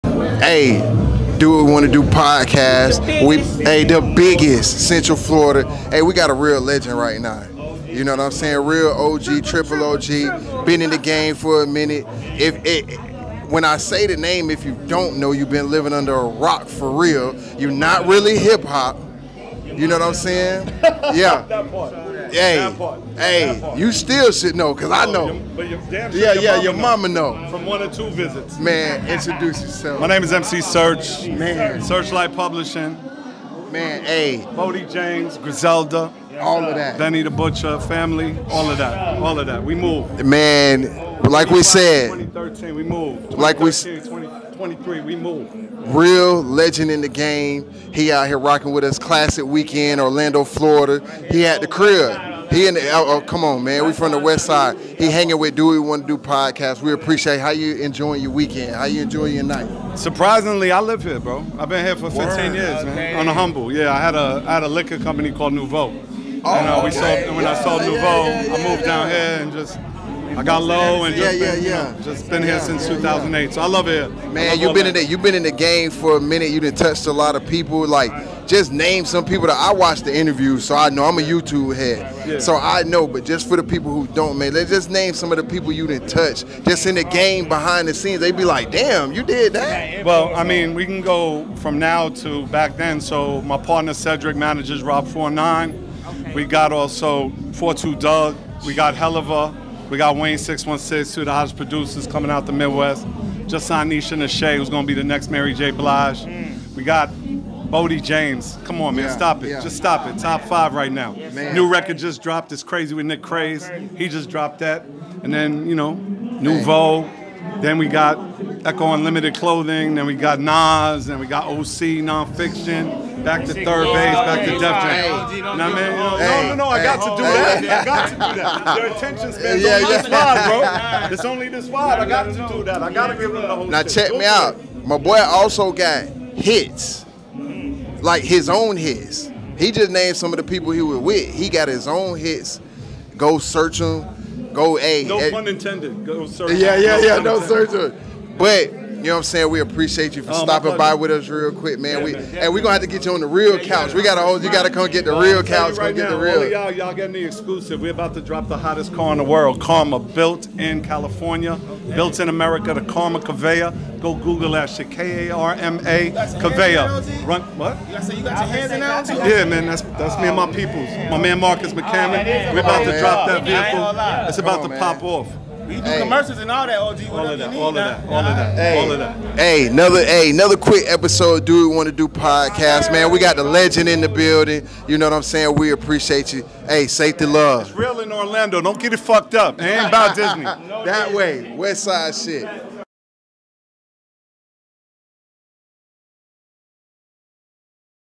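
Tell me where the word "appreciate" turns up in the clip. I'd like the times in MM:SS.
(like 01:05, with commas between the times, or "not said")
00:56, 02:29, 03:05.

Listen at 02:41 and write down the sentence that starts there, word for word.
built in America, the Karma Kaveya.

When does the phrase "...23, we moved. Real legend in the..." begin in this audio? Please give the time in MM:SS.
00:44.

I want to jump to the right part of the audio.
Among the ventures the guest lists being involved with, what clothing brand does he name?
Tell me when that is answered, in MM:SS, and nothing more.
01:58.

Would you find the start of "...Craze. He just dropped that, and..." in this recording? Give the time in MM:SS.
01:53.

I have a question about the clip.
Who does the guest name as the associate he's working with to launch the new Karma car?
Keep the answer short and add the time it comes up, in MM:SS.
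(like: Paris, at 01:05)
Marcus McCammon, at 02:51.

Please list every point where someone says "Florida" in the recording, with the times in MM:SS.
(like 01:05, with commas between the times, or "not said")
00:05, 00:50.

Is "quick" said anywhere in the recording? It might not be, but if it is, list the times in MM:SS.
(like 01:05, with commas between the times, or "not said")
02:31, 03:00.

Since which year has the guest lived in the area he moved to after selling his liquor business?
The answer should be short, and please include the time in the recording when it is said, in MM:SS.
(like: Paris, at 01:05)
2008, at 01:12.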